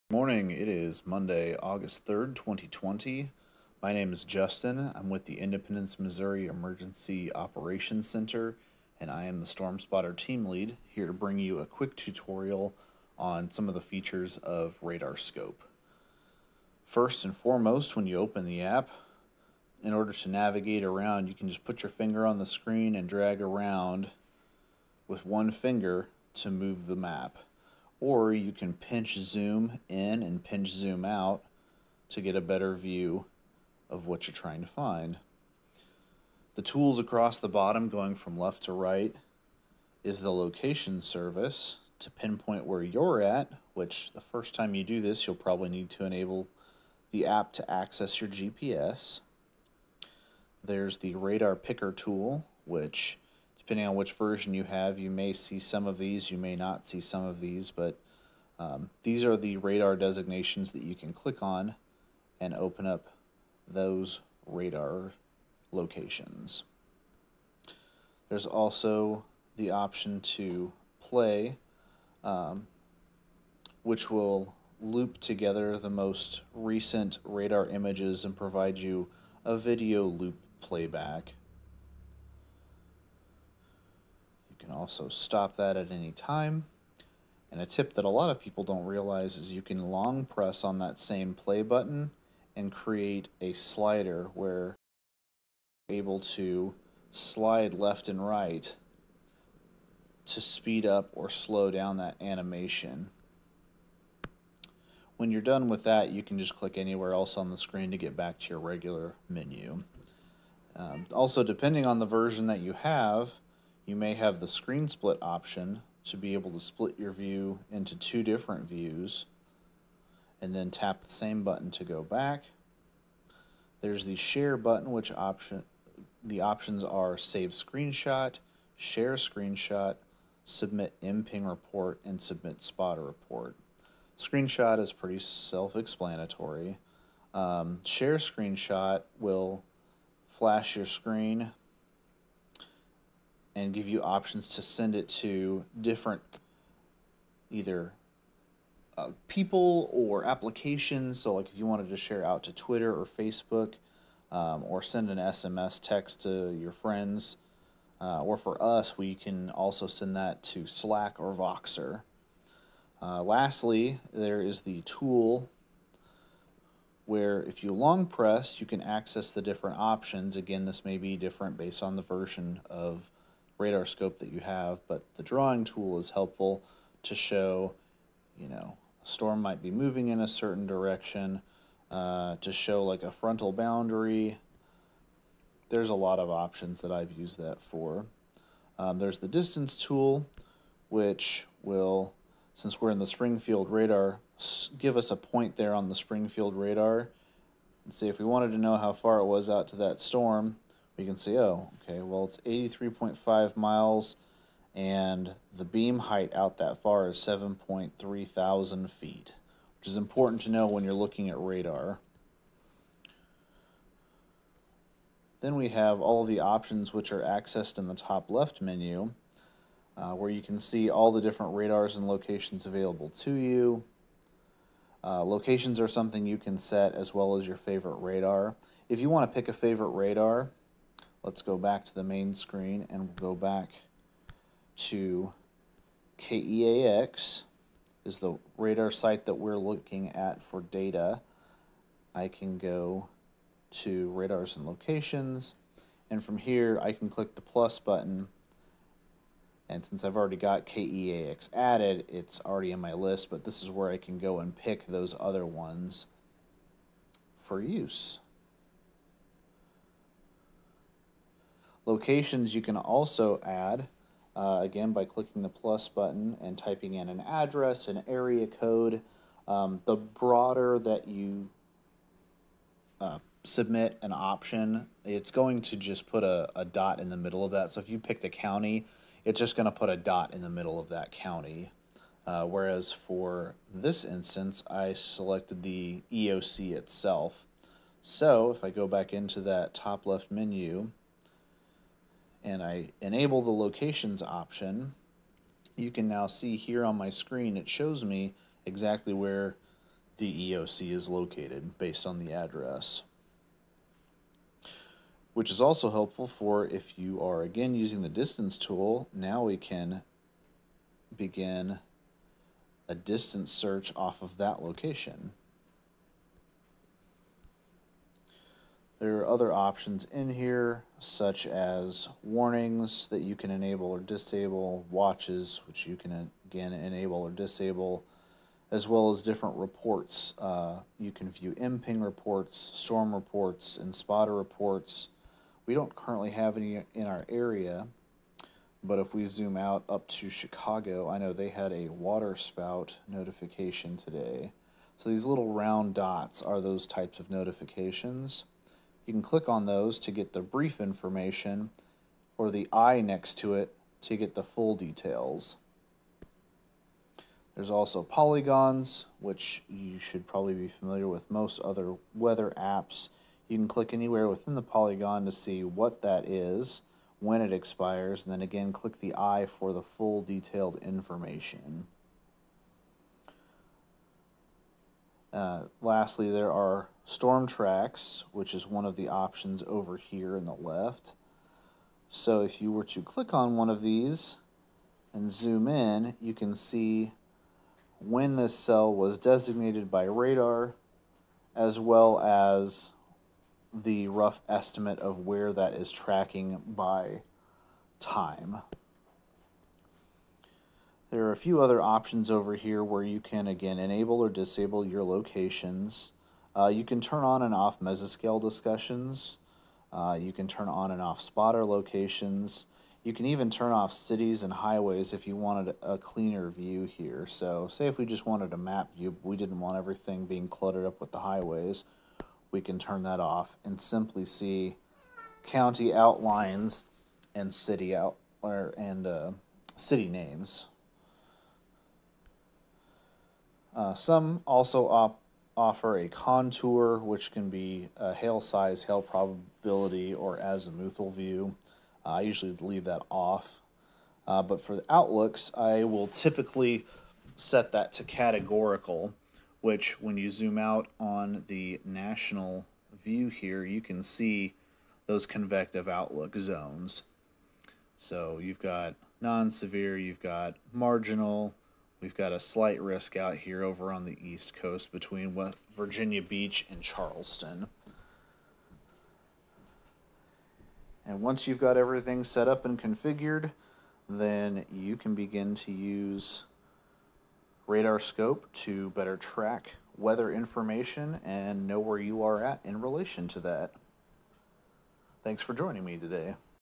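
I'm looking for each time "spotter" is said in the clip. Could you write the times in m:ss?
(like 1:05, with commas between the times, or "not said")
0:09, 2:12, 5:33, 6:51.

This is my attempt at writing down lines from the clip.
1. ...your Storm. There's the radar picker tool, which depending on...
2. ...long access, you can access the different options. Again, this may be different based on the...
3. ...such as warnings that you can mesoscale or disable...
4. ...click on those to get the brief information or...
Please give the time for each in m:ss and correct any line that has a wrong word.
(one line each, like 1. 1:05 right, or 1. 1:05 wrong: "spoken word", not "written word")
1. 0:48 wrong: "GPS", not "Storm"
2. 2:47 wrong: "press", not "access"
3. 5:20 wrong: "enable", not "mesoscale"
4. 5:49 right.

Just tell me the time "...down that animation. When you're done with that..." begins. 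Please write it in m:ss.
1:41.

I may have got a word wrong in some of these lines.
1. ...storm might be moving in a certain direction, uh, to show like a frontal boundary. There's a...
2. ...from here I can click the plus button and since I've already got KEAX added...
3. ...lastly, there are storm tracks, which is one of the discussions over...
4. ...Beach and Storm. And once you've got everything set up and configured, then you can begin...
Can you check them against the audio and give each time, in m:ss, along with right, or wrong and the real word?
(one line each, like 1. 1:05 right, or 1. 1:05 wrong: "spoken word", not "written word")
1. 2:59 right
2. 4:06 right
3. 6:15 wrong: "options", not "discussions"
4. 7:46 wrong: "Charleston", not "Storm".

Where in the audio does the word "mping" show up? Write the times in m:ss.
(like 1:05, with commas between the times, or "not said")
2:11, 5:31.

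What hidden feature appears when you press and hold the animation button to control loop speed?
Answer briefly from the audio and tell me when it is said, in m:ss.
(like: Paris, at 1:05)
A slider, at 1:33.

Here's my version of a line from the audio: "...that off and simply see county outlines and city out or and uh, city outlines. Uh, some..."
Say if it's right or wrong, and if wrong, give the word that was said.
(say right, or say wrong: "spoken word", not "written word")
wrong: "names", not "outlines".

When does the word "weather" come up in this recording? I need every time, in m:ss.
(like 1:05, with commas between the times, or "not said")
6:02, 7:59.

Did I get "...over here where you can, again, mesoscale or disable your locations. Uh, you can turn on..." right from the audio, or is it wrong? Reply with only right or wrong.
wrong.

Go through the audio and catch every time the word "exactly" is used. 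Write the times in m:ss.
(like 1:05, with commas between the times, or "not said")
4:58.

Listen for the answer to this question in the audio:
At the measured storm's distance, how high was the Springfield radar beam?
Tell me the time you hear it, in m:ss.
3:27.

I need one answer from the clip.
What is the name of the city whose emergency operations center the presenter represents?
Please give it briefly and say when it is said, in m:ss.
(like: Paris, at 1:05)
Independence, Missouri, at 0:05.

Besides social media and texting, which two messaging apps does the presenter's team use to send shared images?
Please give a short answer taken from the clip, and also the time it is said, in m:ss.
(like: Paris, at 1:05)
Slack or Voxer, at 2:40.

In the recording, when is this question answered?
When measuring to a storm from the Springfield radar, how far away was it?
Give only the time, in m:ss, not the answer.
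3:22.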